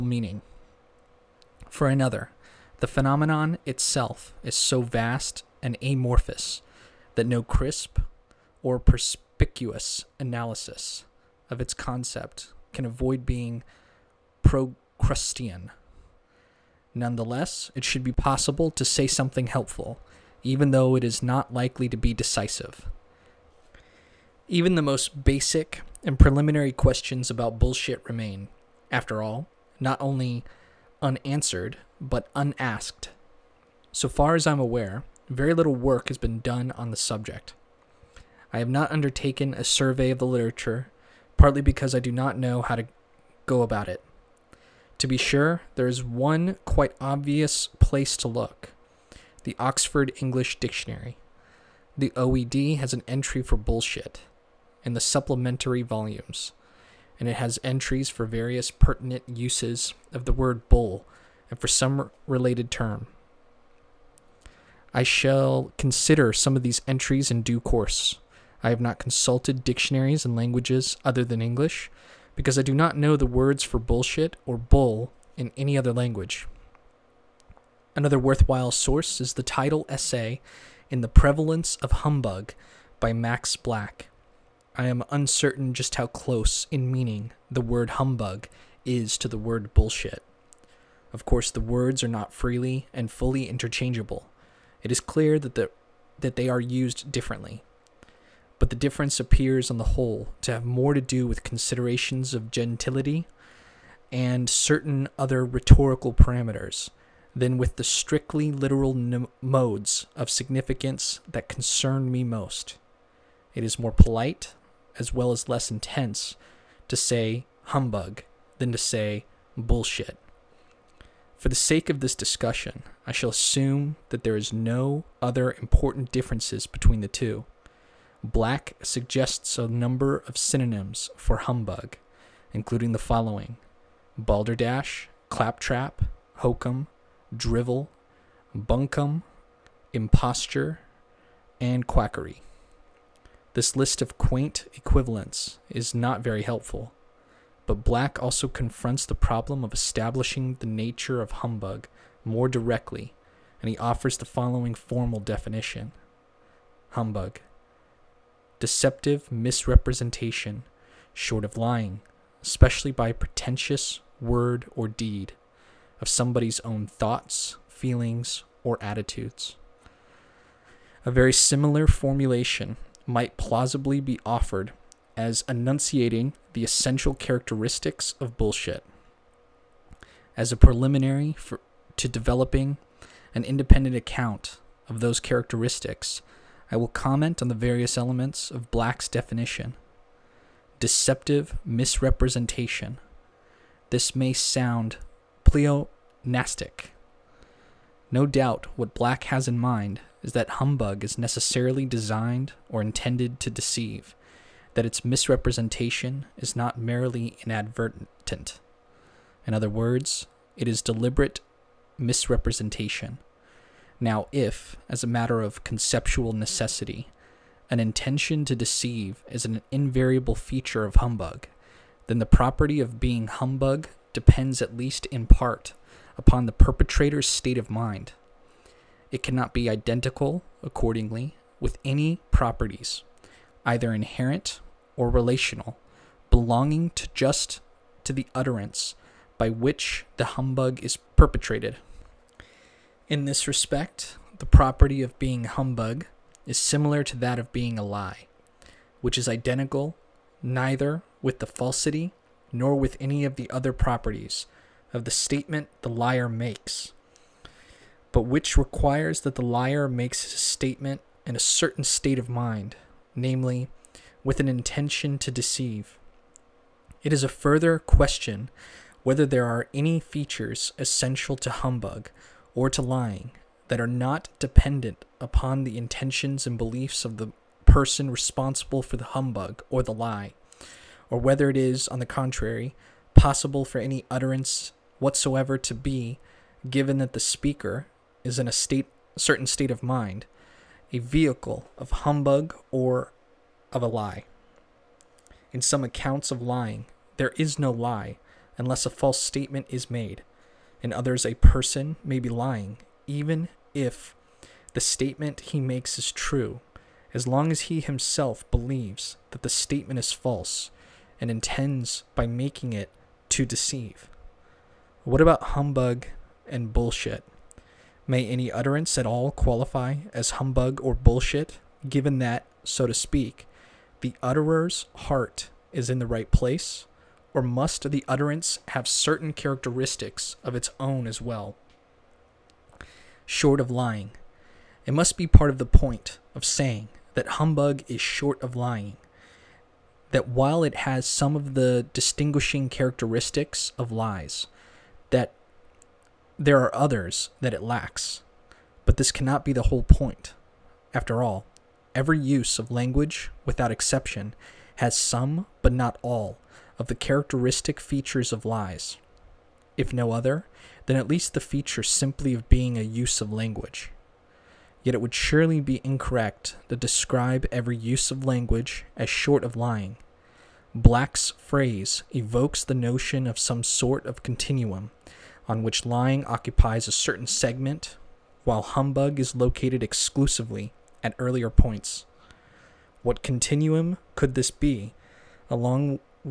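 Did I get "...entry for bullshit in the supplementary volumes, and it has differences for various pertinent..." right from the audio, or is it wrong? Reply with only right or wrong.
wrong.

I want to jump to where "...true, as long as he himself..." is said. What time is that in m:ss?
5:06.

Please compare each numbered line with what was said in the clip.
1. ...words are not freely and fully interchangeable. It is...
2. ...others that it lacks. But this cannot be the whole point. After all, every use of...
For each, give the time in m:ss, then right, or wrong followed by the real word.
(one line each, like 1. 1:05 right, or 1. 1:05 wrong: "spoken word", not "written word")
1. 1:31 right
2. 5:46 right.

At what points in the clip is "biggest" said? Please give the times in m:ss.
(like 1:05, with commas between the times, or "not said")
not said.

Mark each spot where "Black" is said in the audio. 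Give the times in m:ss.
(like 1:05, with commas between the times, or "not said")
1:23, 2:08, 2:27, 3:08, 3:18, 6:10.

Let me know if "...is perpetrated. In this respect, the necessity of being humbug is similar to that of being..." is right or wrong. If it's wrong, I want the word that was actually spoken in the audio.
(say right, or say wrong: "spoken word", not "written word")
wrong: "property", not "necessity".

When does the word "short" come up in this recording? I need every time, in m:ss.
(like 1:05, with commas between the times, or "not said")
2:41, 5:33, 5:38, 6:09.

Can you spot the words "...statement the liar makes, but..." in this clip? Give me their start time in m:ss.
4:15.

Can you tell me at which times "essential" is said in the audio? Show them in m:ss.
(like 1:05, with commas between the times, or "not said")
2:56, 4:30.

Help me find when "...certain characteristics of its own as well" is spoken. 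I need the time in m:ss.
5:28.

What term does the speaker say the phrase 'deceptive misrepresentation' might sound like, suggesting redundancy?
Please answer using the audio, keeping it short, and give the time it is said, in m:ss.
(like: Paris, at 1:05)
pleonastic, at 3:15.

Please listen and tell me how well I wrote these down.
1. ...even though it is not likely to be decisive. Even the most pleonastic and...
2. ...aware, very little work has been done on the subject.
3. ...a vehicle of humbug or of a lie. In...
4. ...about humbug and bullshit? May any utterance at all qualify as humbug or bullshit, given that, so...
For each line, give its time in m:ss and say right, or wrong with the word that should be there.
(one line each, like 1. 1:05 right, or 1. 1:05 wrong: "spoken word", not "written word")
1. 0:20 wrong: "basic", not "pleonastic"
2. 0:34 right
3. 4:50 right
4. 5:15 right.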